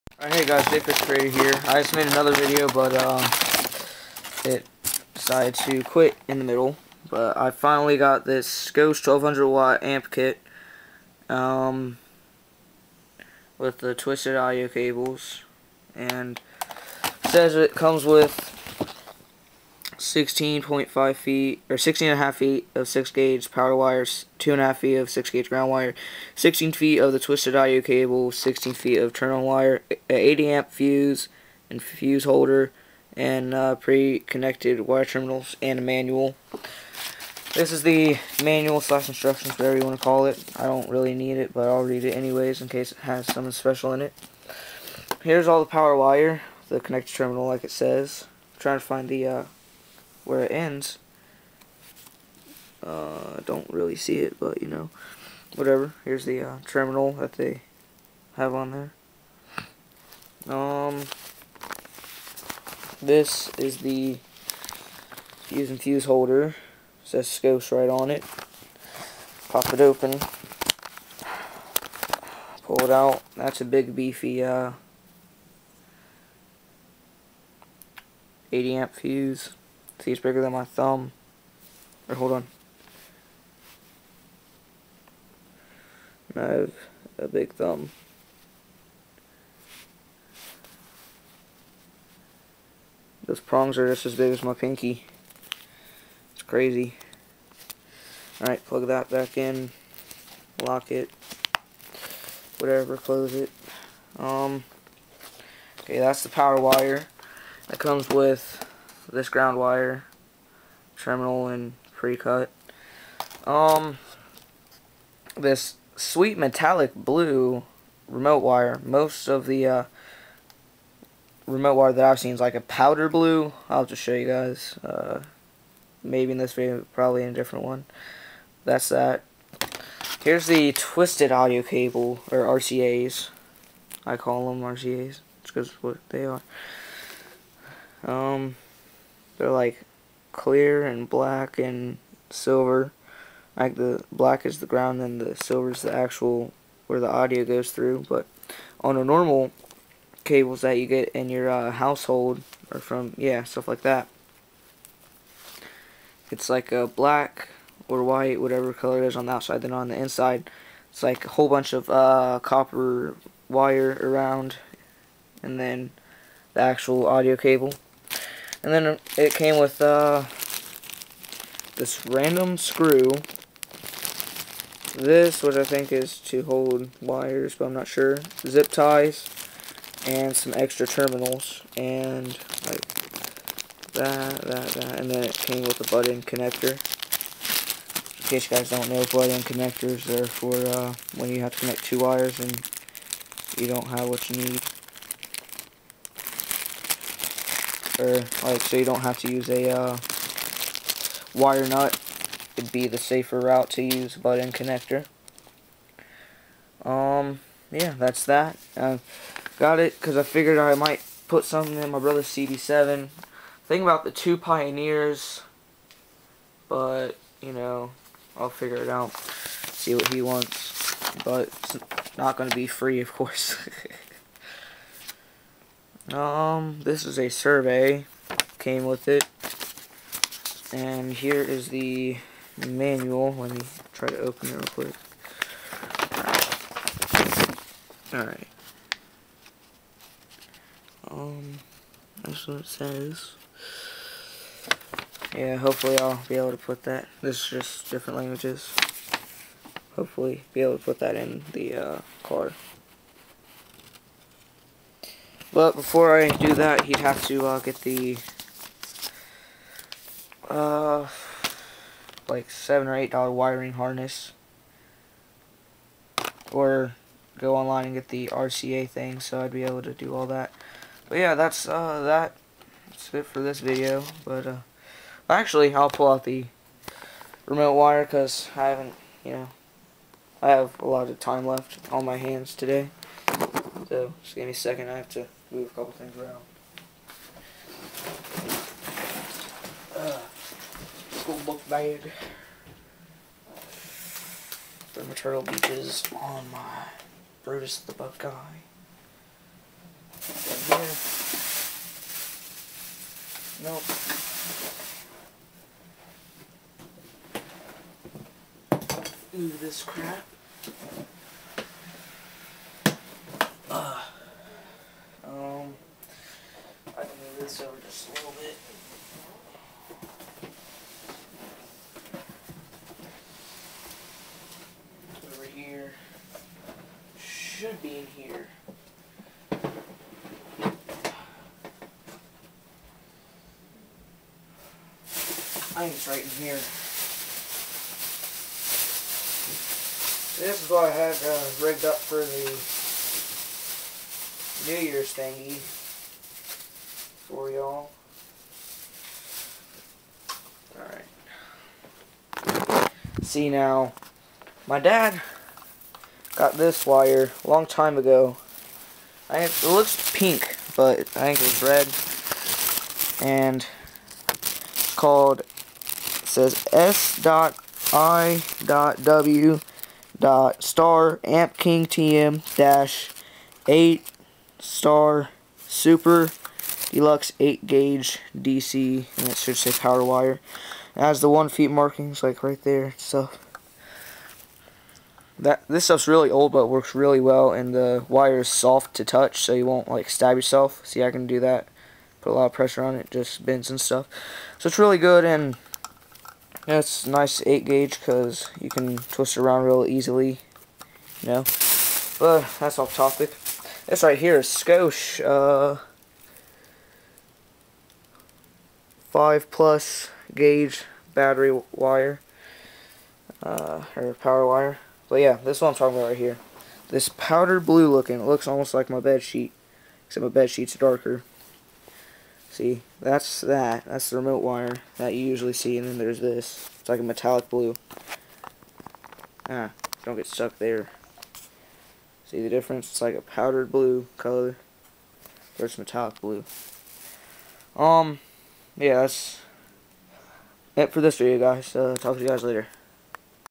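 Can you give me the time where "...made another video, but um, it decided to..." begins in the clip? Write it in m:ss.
0:01.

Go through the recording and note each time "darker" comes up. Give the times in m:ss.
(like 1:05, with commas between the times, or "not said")
7:00.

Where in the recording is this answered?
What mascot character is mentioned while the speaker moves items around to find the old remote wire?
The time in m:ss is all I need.
4:57.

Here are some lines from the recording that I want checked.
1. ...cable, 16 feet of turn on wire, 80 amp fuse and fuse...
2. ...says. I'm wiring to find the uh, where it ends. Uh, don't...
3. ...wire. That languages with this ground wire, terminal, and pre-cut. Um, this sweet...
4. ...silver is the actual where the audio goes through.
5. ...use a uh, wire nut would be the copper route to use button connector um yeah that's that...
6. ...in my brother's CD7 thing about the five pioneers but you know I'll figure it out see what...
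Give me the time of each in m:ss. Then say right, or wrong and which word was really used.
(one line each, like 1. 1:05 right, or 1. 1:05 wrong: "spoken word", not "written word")
1. 0:27 right
2. 0:47 wrong: "trying", not "wiring"
3. 1:46 wrong: "comes", not "languages"
4. 2:25 right
5. 3:19 wrong: "safer", not "copper"
6. 3:31 wrong: "two", not "five".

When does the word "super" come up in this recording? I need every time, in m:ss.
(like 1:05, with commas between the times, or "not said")
6:15.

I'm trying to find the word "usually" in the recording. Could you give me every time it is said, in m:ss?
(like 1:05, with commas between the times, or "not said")
7:05.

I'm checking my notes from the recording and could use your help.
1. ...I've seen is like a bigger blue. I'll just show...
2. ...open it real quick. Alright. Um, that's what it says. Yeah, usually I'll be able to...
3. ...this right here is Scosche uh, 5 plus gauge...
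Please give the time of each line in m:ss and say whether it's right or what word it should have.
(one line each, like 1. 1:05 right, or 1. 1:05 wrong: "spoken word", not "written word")
1. 2:02 wrong: "powder", not "bigger"
2. 3:54 wrong: "hopefully", not "usually"
3. 6:43 right.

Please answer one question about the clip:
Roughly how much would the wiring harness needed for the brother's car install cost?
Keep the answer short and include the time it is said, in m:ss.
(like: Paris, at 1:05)
7 or 8 dollars, at 4:22.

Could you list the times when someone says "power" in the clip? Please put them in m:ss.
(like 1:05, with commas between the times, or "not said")
0:23, 0:45, 1:46, 6:19, 6:54.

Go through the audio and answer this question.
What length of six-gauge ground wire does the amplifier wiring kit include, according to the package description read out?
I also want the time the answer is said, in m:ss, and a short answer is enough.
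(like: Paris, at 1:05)
2.5 feet, at 0:24.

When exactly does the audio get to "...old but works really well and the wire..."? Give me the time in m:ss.
6:26.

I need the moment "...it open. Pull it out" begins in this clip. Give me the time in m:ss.
1:09.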